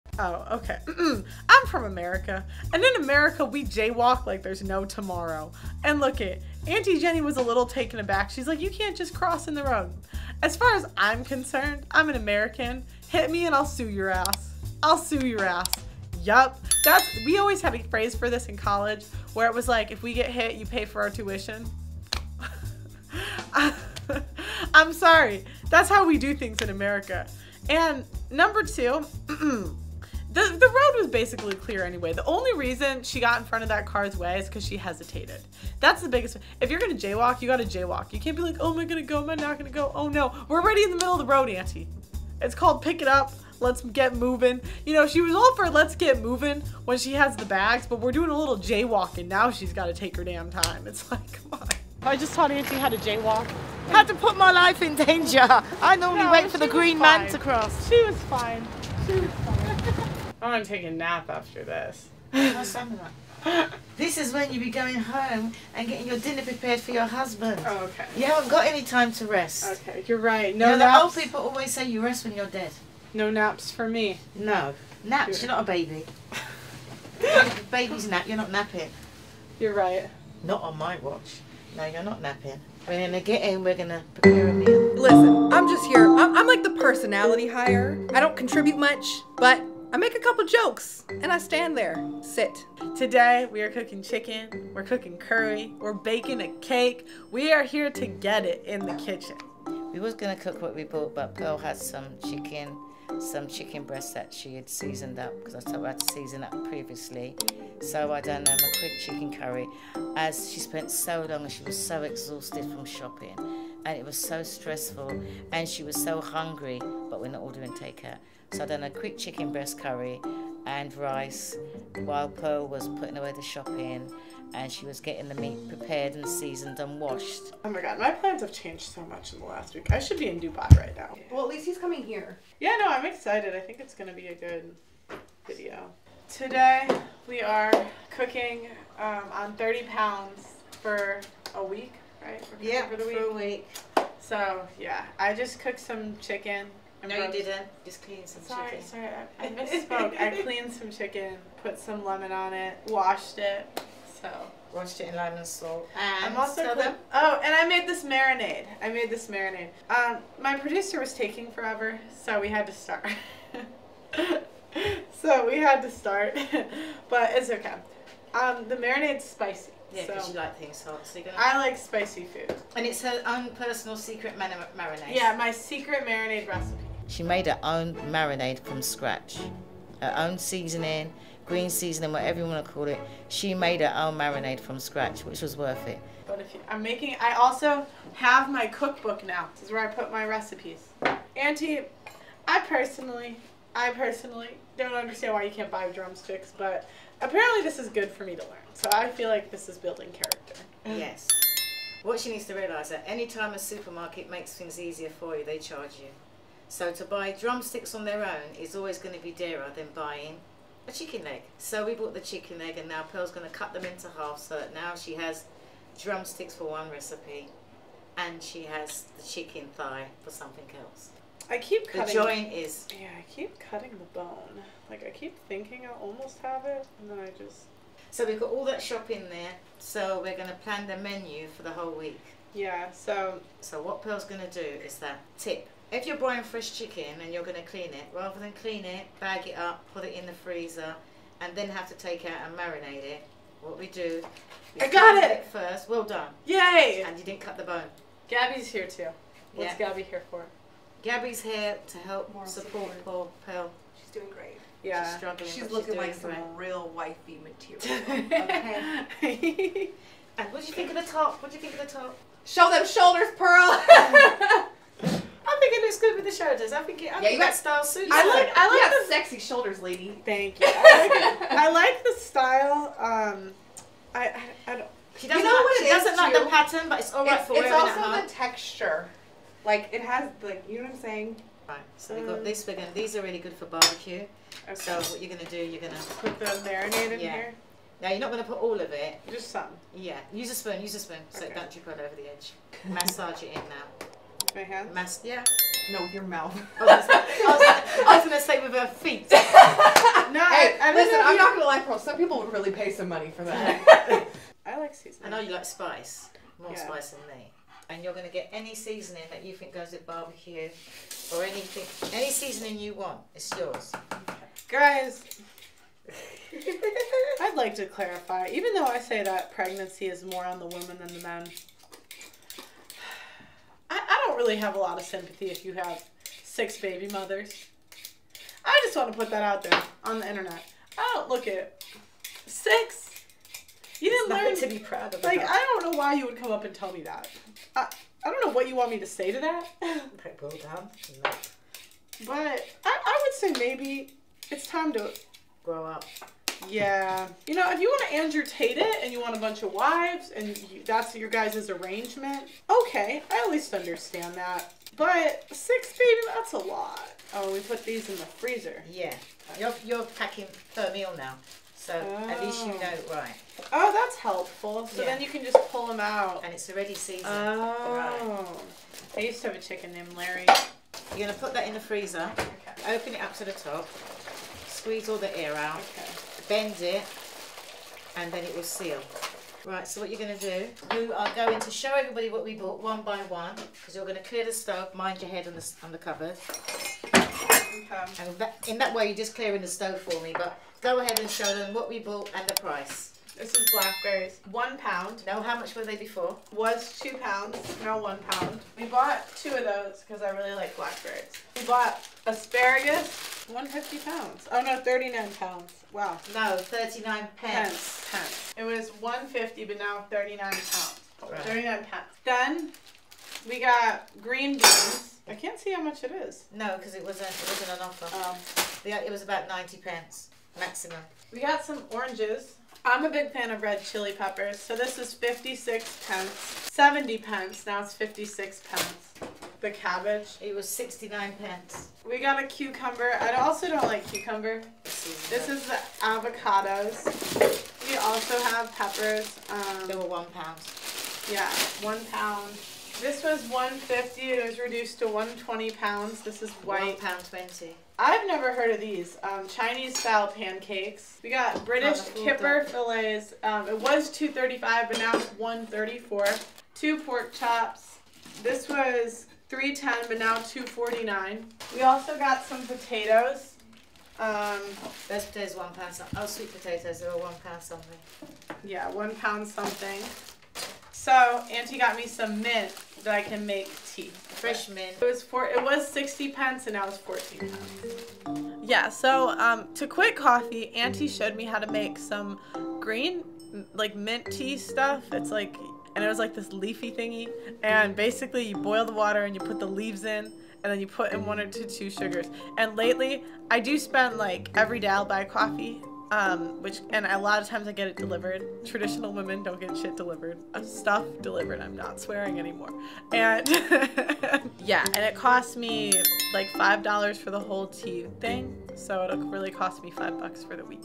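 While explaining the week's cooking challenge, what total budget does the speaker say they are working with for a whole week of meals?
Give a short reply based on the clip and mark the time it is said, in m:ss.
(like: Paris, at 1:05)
30 pounds, at 2:19.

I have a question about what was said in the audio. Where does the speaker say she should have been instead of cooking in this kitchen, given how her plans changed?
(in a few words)
Dubai.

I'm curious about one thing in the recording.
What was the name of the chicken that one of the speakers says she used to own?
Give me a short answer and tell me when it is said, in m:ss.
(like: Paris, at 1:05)
Larry, at 6:10.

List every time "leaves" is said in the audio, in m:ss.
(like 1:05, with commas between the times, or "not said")
8:09.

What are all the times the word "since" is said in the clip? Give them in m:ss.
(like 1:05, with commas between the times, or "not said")
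not said.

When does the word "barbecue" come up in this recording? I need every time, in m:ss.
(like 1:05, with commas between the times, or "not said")
4:43, 5:10.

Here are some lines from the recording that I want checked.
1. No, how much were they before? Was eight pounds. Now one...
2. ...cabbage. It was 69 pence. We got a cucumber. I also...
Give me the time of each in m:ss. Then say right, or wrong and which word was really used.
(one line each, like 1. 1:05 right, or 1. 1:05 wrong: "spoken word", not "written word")
1. 6:35 wrong: "two", not "eight"
2. 7:09 right.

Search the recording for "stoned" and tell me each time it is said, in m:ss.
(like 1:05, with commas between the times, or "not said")
not said.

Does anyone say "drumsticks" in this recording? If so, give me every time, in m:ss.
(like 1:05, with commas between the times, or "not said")
3:15, 3:27, 3:36.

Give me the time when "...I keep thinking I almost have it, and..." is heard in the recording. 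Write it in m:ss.
3:45.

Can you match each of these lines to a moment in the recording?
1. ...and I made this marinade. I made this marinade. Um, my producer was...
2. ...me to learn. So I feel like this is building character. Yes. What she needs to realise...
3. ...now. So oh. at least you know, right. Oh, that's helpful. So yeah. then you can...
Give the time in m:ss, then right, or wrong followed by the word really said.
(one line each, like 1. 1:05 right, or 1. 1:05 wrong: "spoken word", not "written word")
1. 2:37 right
2. 3:18 right
3. 6:01 right.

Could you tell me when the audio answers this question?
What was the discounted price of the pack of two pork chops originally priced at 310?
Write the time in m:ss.
7:40.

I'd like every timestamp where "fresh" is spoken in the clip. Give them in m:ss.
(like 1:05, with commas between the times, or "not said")
3:56, 7:54.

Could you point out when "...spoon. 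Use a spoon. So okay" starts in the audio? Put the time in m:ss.
4:50.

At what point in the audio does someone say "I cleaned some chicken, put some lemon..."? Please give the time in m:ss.
2:30.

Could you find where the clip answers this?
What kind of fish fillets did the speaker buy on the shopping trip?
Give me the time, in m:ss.
7:32.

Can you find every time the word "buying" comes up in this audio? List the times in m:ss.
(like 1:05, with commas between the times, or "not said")
3:29, 3:56.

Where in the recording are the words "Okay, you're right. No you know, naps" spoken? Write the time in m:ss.
1:09.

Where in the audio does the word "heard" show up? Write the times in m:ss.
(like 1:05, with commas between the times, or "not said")
7:28.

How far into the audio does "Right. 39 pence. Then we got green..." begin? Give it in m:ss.
6:51.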